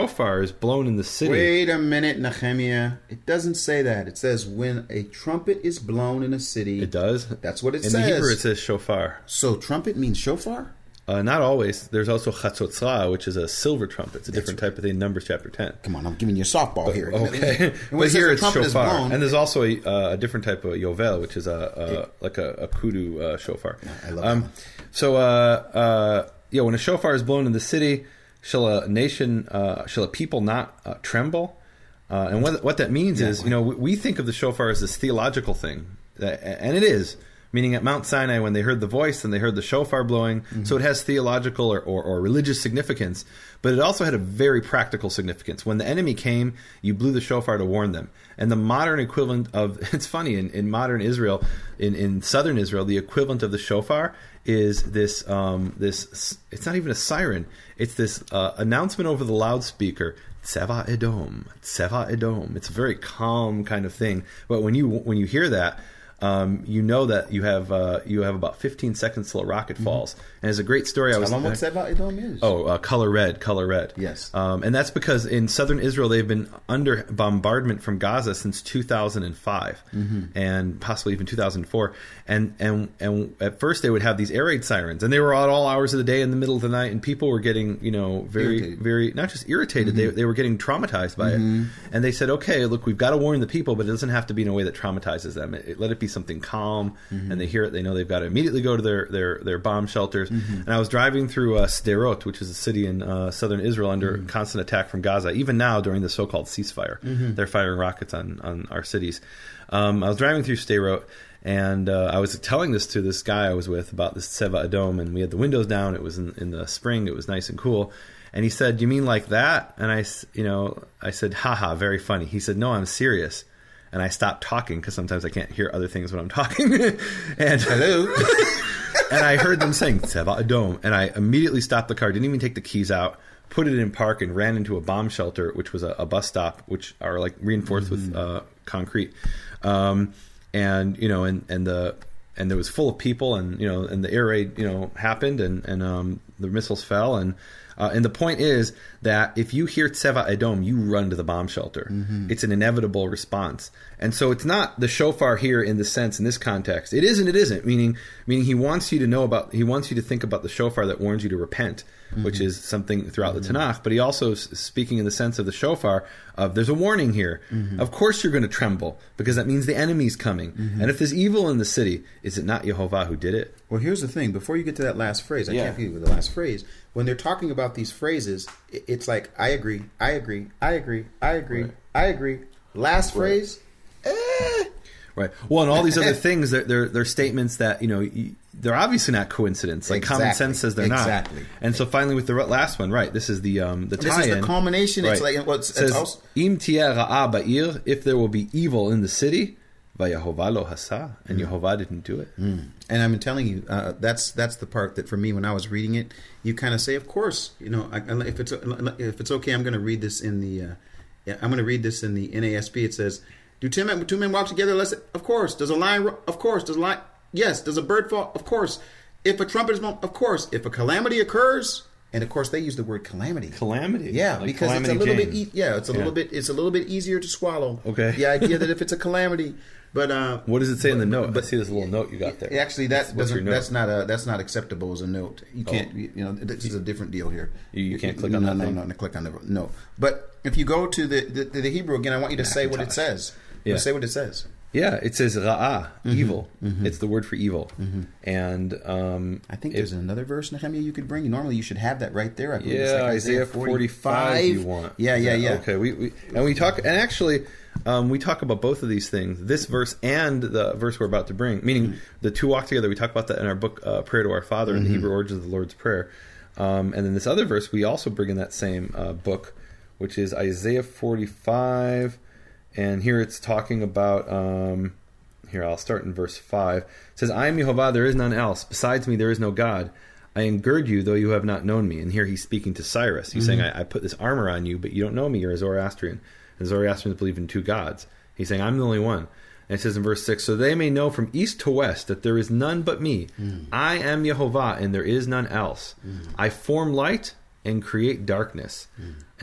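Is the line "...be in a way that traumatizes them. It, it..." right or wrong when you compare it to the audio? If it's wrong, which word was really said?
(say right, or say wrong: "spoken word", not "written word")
right.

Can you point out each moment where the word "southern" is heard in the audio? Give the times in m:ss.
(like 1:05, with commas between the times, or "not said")
0:52, 1:15, 1:43.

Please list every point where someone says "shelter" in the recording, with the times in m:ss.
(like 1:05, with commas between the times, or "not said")
1:39, 2:15, 2:31.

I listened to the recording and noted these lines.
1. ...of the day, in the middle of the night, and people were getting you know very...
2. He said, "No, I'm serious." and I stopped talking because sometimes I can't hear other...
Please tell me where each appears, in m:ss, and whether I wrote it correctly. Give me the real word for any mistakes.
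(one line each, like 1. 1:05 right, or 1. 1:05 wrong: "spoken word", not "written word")
1. 1:25 right
2. 2:02 right.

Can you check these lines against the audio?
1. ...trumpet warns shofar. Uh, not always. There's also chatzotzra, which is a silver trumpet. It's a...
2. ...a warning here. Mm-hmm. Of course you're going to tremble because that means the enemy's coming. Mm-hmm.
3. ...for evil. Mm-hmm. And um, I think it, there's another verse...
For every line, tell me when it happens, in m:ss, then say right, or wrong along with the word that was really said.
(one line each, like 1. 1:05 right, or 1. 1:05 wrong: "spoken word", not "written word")
1. 0:09 wrong: "means", not "warns"
2. 2:46 right
3. 4:07 right.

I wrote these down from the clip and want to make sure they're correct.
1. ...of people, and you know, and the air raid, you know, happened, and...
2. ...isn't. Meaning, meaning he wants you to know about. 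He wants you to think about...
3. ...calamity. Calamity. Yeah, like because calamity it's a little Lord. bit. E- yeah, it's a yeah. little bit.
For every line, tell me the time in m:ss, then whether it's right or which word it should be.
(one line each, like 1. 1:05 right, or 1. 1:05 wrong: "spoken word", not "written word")
1. 2:22 right
2. 2:37 right
3. 3:43 wrong: "James", not "Lord".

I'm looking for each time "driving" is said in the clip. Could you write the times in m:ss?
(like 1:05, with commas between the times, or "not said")
1:40, 1:50.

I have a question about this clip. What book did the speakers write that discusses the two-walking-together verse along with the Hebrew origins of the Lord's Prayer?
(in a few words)
Prayer to Our Father.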